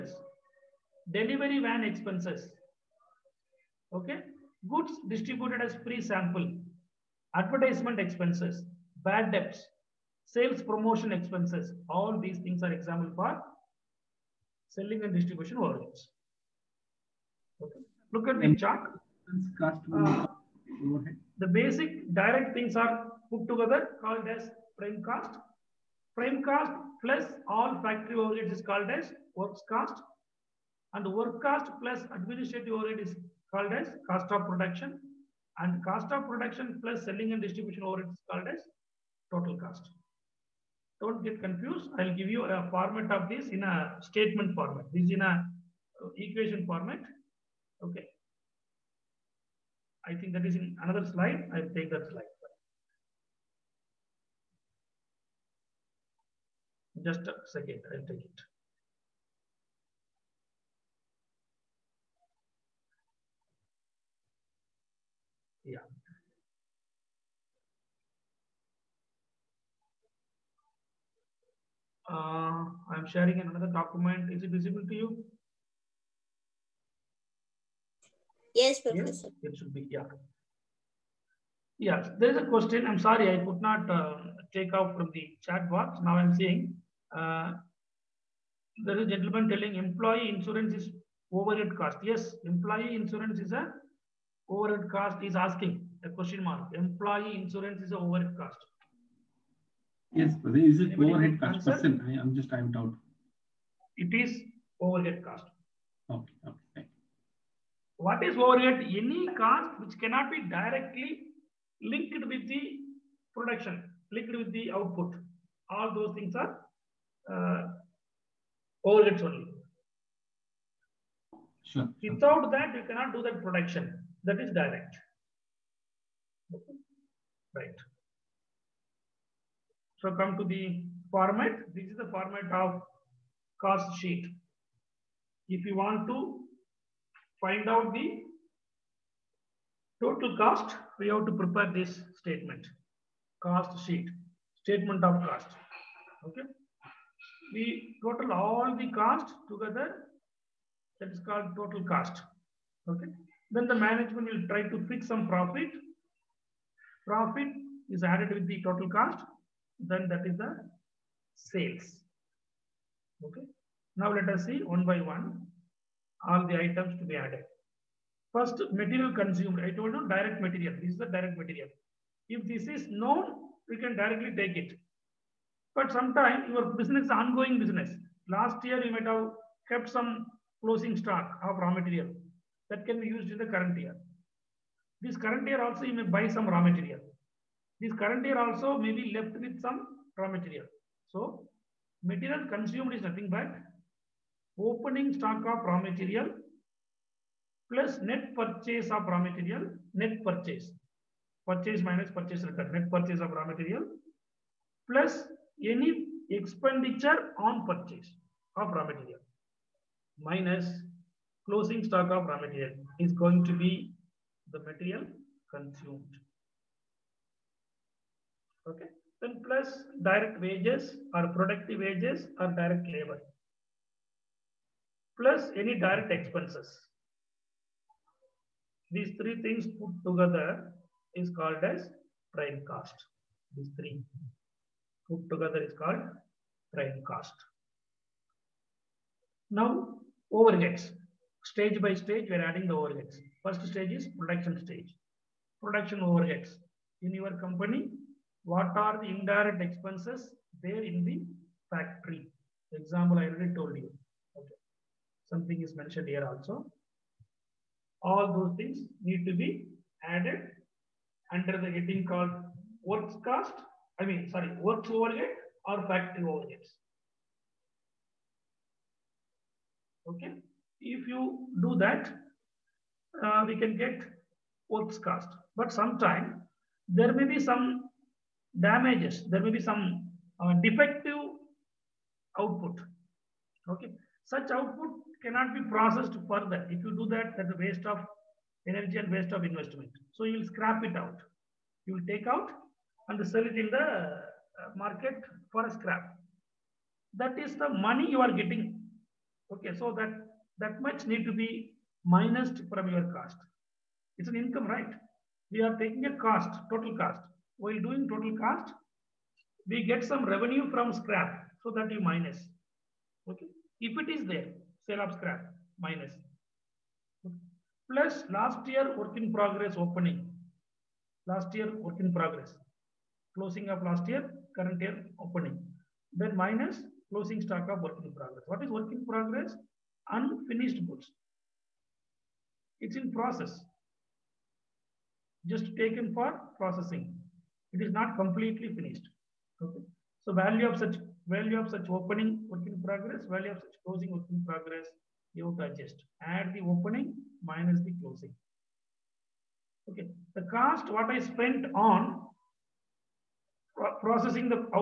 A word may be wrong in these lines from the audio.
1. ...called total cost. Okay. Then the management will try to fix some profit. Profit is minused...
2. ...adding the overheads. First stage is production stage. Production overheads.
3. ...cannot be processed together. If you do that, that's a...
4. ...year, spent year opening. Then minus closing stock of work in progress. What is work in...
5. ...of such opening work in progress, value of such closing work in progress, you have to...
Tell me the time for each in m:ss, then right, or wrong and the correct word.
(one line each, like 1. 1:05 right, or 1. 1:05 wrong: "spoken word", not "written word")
1. 2:31 wrong: "added", not "minused"
2. 4:02 right
3. 4:45 wrong: "further", not "together"
4. 5:24 wrong: "current", not "spent"
5. 5:41 right.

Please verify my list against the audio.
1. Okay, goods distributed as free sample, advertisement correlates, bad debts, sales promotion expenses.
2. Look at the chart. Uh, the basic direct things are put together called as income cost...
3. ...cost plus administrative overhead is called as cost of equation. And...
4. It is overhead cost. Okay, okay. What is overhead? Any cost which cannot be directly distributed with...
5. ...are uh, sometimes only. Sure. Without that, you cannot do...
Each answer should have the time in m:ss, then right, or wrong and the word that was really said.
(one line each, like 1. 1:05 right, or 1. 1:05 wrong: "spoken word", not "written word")
1. 0:03 wrong: "expenses", not "correlates"
2. 0:18 wrong: "prime", not "income"
3. 0:31 wrong: "production", not "equation"
4. 1:43 wrong: "linked", not "distributed"
5. 1:56 wrong: "correlates", not "sometimes".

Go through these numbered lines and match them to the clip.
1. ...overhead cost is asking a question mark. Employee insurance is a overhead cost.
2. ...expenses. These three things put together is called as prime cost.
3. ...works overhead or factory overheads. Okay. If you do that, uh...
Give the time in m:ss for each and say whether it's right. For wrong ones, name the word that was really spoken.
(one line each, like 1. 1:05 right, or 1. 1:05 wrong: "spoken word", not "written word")
1. 1:34 right
2. 3:46 right
3. 4:24 right.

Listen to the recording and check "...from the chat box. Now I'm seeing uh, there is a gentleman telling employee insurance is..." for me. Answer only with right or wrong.
right.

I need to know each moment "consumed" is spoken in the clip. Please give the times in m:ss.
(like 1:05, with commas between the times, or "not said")
2:49, 3:12, 3:35.